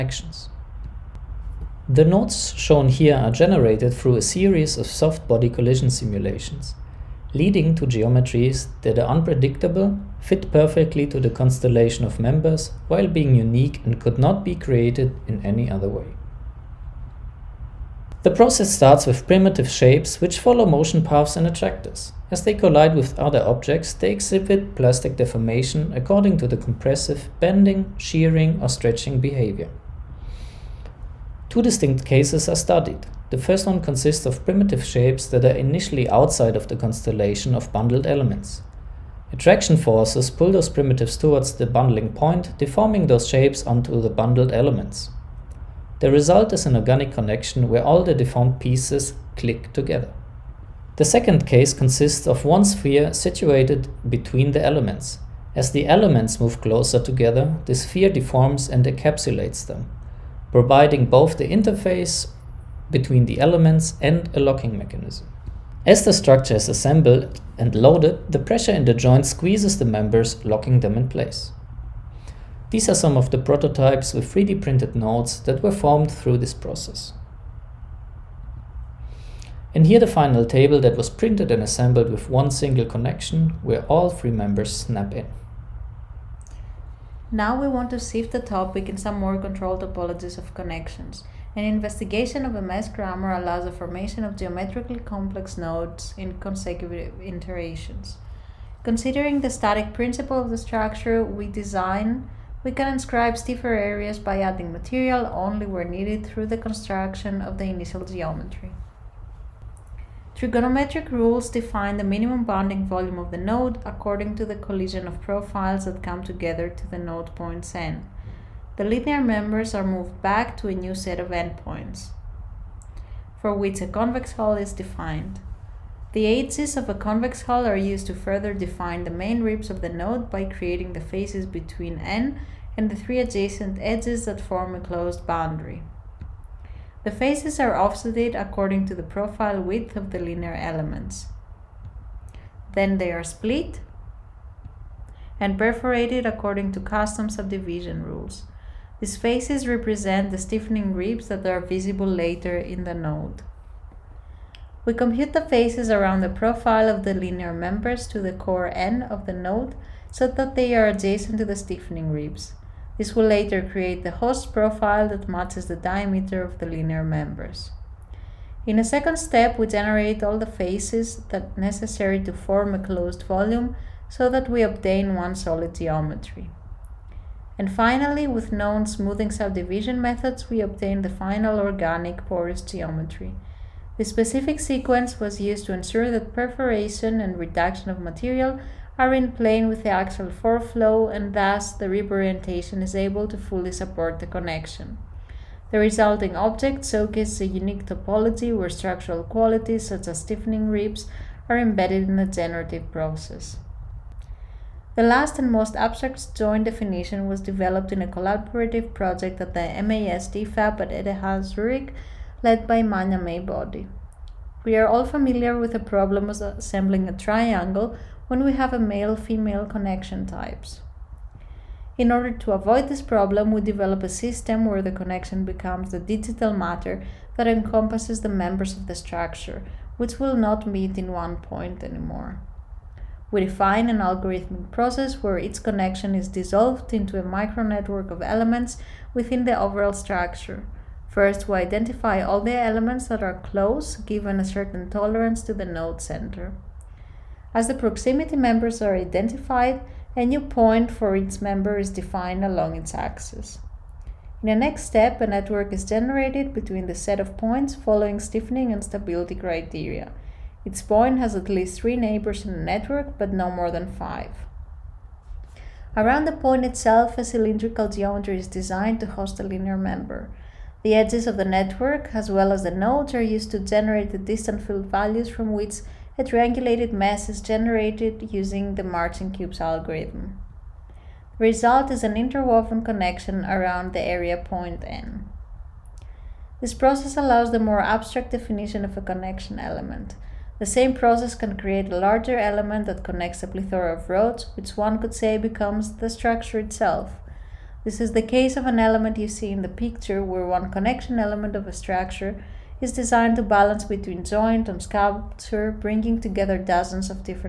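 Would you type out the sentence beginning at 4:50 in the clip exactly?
The same process can create a larger element that connects a plethora of roads, which one could say becomes the structure itself.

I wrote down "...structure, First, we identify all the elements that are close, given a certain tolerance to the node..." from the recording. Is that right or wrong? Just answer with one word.
right.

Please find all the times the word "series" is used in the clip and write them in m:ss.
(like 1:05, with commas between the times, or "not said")
0:04.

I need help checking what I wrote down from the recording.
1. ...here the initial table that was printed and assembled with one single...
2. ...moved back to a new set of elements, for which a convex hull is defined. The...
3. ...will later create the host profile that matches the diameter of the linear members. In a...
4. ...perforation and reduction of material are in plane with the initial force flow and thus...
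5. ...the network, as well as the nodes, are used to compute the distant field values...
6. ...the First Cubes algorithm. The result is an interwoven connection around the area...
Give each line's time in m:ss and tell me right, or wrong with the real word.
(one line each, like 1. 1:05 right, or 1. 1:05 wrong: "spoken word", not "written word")
1. 1:19 wrong: "final", not "initial"
2. 1:59 wrong: "endpoints", not "elements"
3. 2:43 right
4. 3:06 wrong: "axial", not "initial"
5. 4:31 wrong: "generate", not "compute"
6. 4:38 wrong: "Marching", not "First".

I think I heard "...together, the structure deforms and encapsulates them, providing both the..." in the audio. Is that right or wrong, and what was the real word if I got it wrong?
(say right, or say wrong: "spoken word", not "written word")
wrong: "sphere", not "structure".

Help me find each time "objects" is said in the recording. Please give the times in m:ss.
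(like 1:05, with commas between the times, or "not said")
0:23, 3:16.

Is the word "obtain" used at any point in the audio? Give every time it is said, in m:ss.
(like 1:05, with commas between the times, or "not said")
2:54, 3:00.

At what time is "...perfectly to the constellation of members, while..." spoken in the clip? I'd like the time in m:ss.
0:10.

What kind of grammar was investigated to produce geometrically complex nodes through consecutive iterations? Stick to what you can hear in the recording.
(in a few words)
mesh grammar.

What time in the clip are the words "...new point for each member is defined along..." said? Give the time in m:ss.
4:10.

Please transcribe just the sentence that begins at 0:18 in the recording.
The process starts with primitive shapes which follow motion paths and attractors.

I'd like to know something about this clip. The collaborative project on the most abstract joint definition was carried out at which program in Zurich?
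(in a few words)
MAS DFAB.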